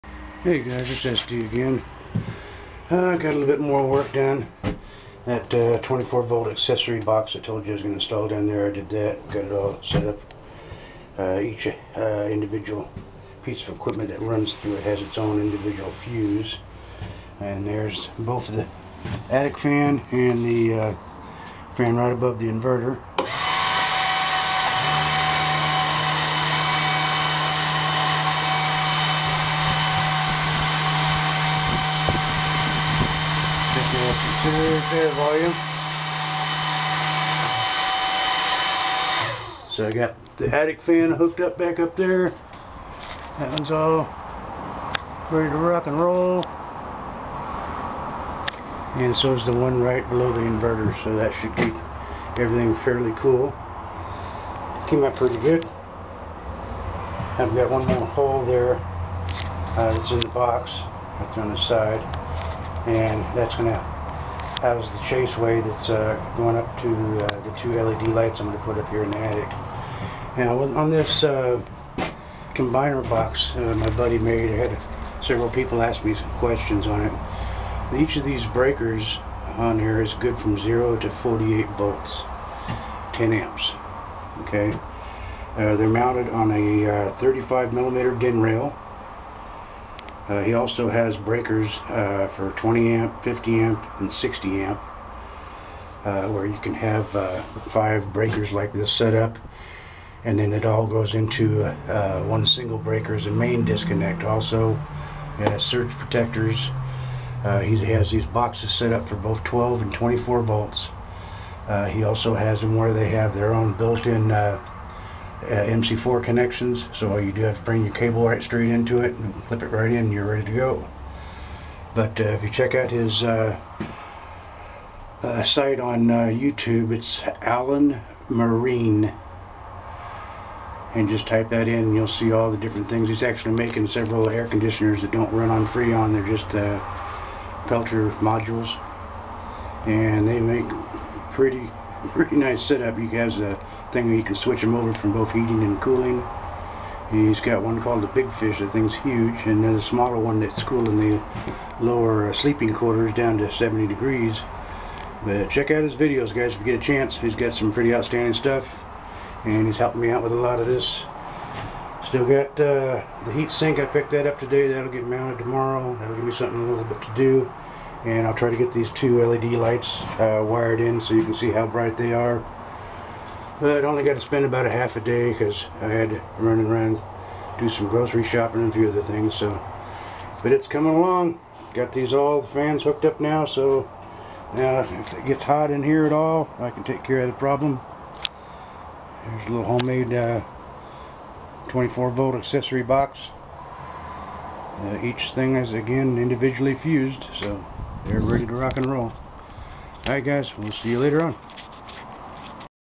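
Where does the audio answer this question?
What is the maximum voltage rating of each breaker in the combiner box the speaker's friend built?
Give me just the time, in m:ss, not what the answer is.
1:21.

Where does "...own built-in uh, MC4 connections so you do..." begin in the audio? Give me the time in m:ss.
1:53.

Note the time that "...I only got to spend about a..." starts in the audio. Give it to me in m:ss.
2:53.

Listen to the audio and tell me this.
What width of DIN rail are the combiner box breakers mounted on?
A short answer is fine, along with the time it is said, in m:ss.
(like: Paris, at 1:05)
35 millimeter, at 1:27.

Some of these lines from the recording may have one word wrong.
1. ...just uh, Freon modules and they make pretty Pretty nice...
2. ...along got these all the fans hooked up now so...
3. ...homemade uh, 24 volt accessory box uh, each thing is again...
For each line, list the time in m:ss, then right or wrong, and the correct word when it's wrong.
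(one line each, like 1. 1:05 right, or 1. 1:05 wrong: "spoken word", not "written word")
1. 2:16 wrong: "Peltier", not "Freon"
2. 3:00 right
3. 3:09 right.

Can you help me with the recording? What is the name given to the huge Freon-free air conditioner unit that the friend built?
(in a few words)
Big Fish.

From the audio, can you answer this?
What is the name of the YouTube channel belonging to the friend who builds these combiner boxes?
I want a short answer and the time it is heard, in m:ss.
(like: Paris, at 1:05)
Alan Marine, at 2:07.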